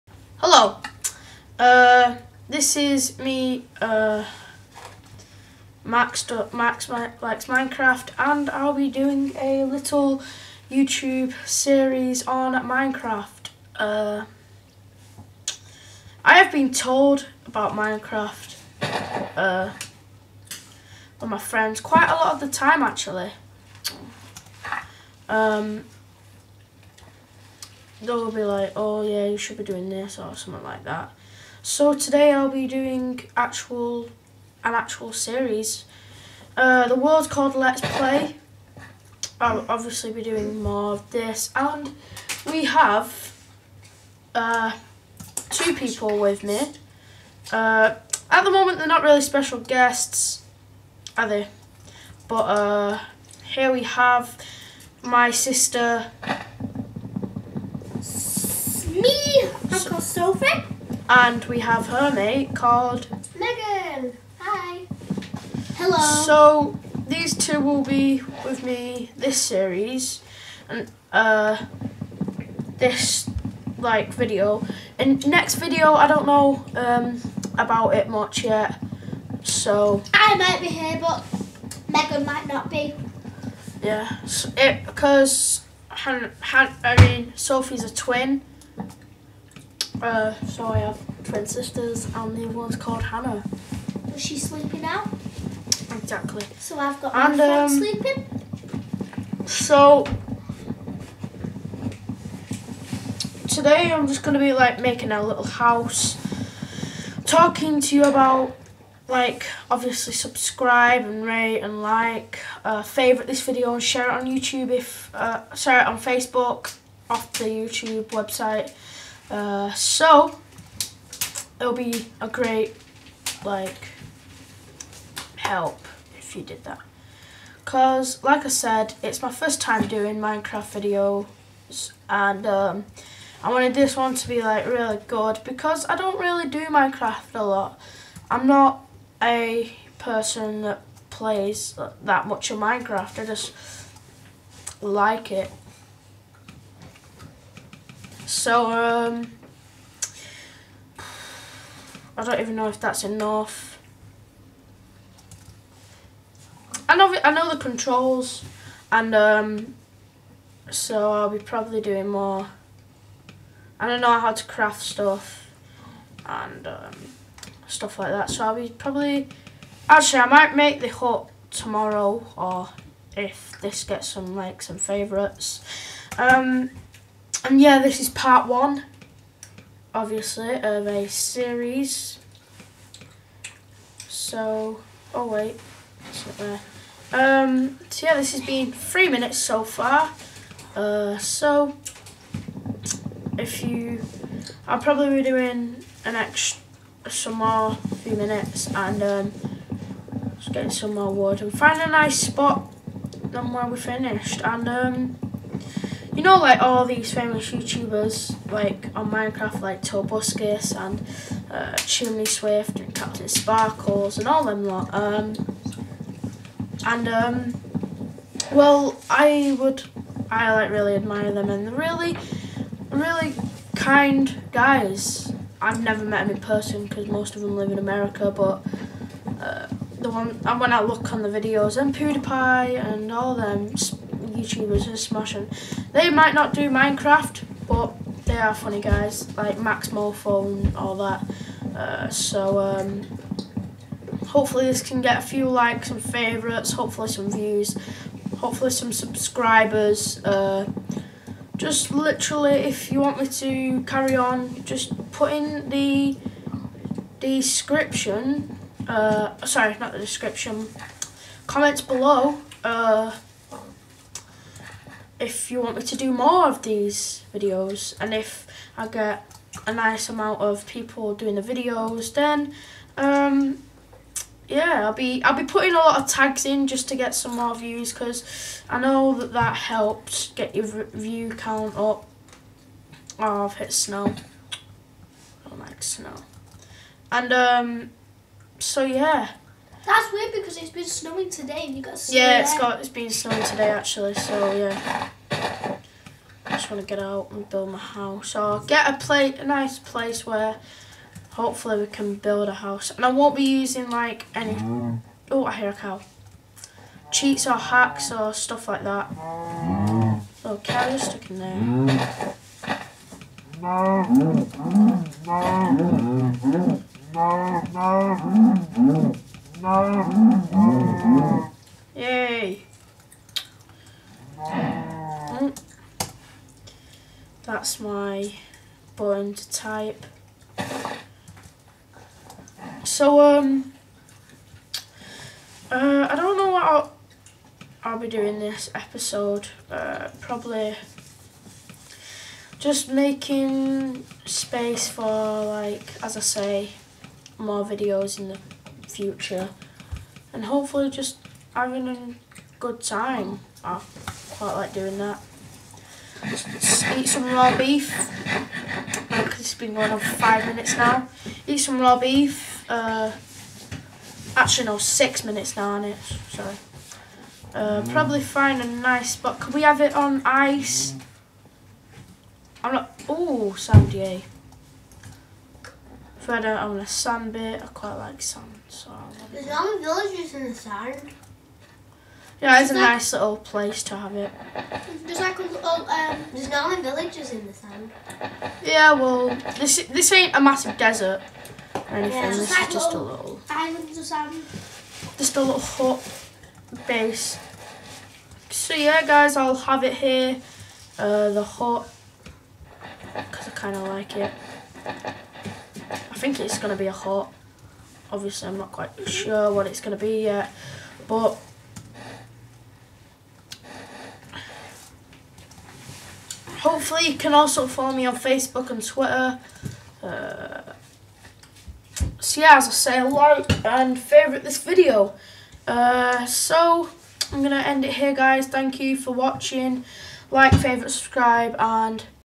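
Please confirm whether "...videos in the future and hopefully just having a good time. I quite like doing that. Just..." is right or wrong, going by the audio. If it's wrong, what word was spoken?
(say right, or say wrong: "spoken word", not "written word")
right.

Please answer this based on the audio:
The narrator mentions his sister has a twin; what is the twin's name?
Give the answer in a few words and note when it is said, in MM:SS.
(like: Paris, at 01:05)
Hannah, at 01:33.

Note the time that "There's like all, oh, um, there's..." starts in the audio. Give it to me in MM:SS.
06:25.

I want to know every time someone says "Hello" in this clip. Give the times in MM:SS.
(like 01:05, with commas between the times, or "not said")
00:00, 01:05.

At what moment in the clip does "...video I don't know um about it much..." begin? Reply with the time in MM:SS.
01:15.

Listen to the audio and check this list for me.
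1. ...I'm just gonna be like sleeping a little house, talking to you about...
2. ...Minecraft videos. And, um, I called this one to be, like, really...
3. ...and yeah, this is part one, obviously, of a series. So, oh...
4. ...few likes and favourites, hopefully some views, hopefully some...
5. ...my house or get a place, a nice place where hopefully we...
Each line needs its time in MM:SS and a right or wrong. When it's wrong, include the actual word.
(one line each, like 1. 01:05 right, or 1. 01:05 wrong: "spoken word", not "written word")
1. 01:43 wrong: "making", not "sleeping"
2. 02:10 wrong: "wanted", not "called"
3. 02:57 right
4. 04:05 right
5. 04:57 right.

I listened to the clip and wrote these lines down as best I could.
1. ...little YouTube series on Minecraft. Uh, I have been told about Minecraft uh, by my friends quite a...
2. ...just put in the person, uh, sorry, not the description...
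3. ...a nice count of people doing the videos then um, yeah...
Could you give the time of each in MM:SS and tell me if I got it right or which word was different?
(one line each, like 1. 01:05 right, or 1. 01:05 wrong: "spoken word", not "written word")
1. 00:09 right
2. 04:14 wrong: "description", not "person"
3. 04:29 wrong: "amount", not "count".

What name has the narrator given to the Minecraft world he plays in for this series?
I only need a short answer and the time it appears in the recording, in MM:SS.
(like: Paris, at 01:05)
Let's Play, at 00:37.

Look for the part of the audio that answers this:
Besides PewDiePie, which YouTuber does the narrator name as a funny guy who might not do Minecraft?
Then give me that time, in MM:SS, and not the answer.
03:59.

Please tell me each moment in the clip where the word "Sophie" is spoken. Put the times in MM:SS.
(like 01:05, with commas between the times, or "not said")
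01:00, 01:27.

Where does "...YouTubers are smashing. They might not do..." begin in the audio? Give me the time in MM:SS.
03:54.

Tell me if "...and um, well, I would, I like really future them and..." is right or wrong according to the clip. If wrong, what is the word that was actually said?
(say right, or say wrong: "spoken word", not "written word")
wrong: "admire", not "future".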